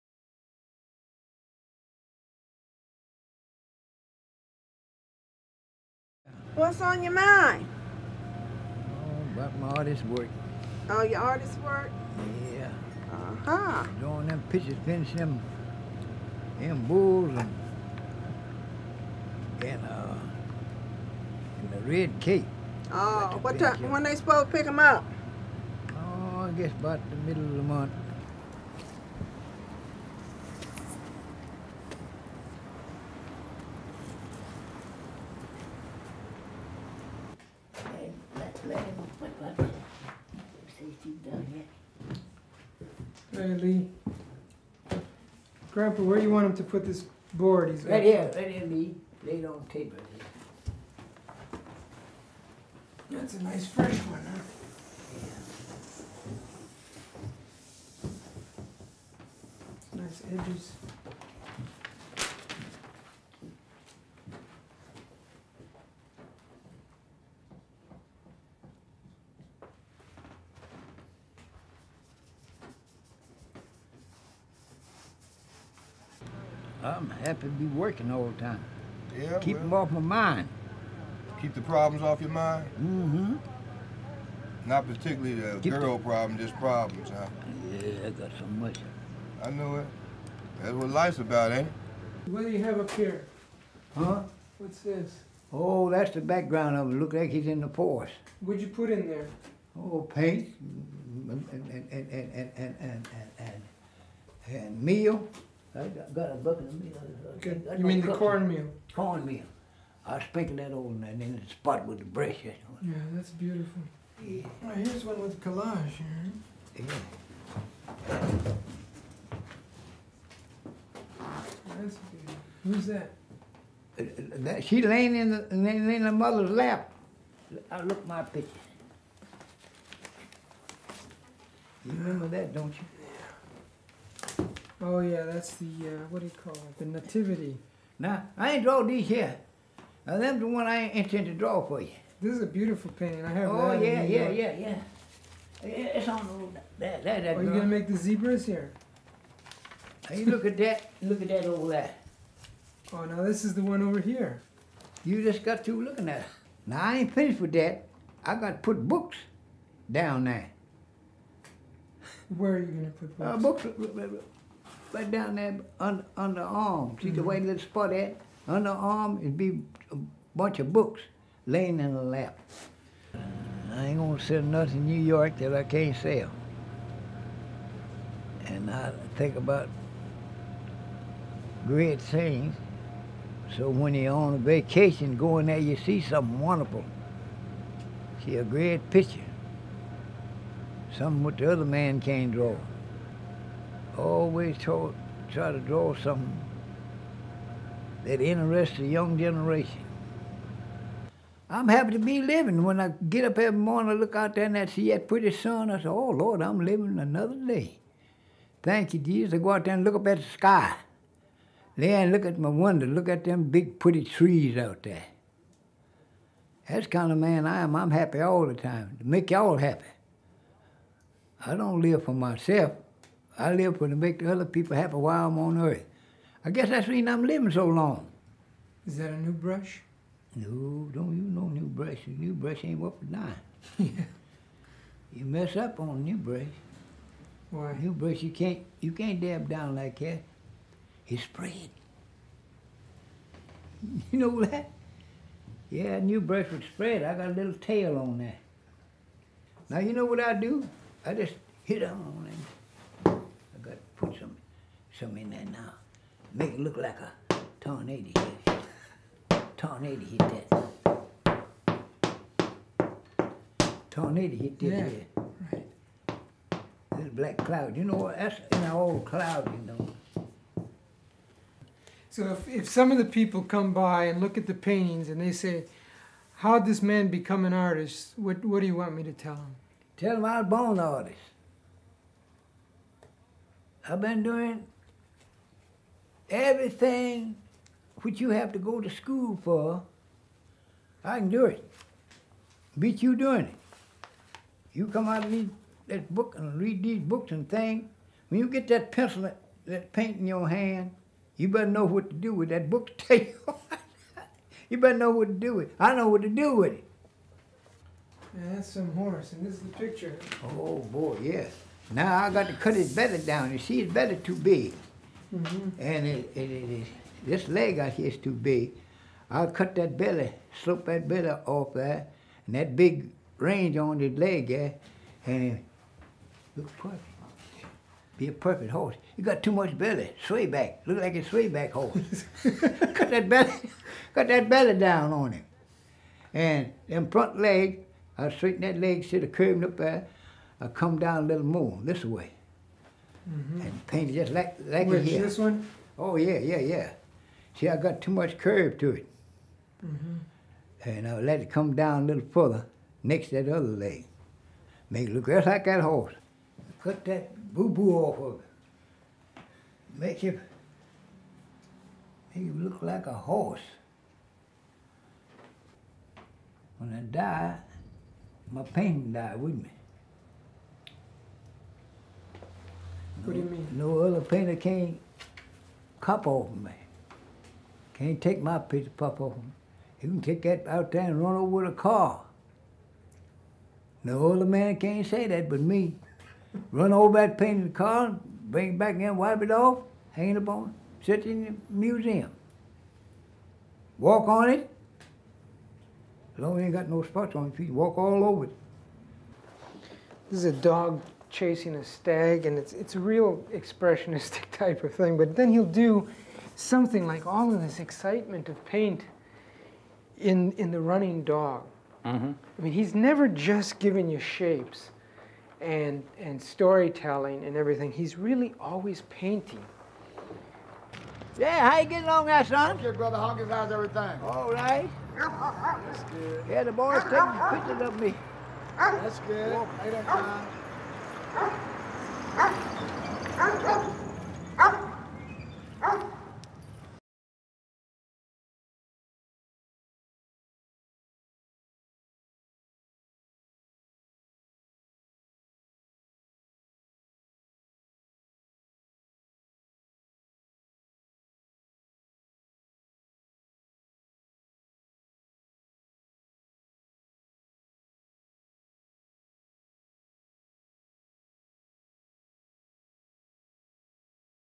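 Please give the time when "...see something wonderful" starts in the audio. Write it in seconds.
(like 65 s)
185 s.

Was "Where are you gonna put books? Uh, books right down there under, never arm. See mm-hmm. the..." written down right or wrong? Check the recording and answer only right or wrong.
wrong.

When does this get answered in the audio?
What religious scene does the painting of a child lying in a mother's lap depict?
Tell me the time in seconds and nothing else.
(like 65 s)
136 s.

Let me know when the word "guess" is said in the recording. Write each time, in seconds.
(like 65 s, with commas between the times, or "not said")
26 s, 226 s.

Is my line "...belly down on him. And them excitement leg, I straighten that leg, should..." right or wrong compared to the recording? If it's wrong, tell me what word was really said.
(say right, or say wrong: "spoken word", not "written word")
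wrong: "front", not "excitement".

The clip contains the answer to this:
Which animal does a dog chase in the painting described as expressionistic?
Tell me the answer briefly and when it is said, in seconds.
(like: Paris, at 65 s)
A stag, at 401 s.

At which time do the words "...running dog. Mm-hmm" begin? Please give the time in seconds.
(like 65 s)
410 s.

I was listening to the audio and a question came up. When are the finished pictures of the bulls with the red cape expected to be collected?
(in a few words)
Middle of the month.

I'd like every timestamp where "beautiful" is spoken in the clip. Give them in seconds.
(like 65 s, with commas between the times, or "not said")
113 s, 122 s, 142 s.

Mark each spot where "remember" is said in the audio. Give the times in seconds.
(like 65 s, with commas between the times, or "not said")
131 s.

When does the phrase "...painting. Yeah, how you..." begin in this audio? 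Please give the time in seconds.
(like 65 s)
419 s.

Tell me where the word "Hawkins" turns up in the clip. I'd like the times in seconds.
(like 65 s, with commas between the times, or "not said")
423 s.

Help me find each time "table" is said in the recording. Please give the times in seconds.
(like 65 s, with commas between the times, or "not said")
49 s.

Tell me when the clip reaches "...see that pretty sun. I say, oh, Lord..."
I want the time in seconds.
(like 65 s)
204 s.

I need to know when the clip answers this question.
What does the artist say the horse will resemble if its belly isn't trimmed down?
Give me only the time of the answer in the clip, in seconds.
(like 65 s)
331 s.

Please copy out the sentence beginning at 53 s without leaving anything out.
That's a nice fresh one, huh?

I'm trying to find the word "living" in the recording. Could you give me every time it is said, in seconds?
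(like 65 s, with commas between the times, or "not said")
202 s, 206 s, 227 s.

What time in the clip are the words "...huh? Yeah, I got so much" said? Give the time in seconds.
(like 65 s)
87 s.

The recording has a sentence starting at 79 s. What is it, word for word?
Yeah, Keep well, them off my mind.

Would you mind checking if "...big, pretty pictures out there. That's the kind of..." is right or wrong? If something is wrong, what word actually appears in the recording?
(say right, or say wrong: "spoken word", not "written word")
wrong: "trees", not "pictures".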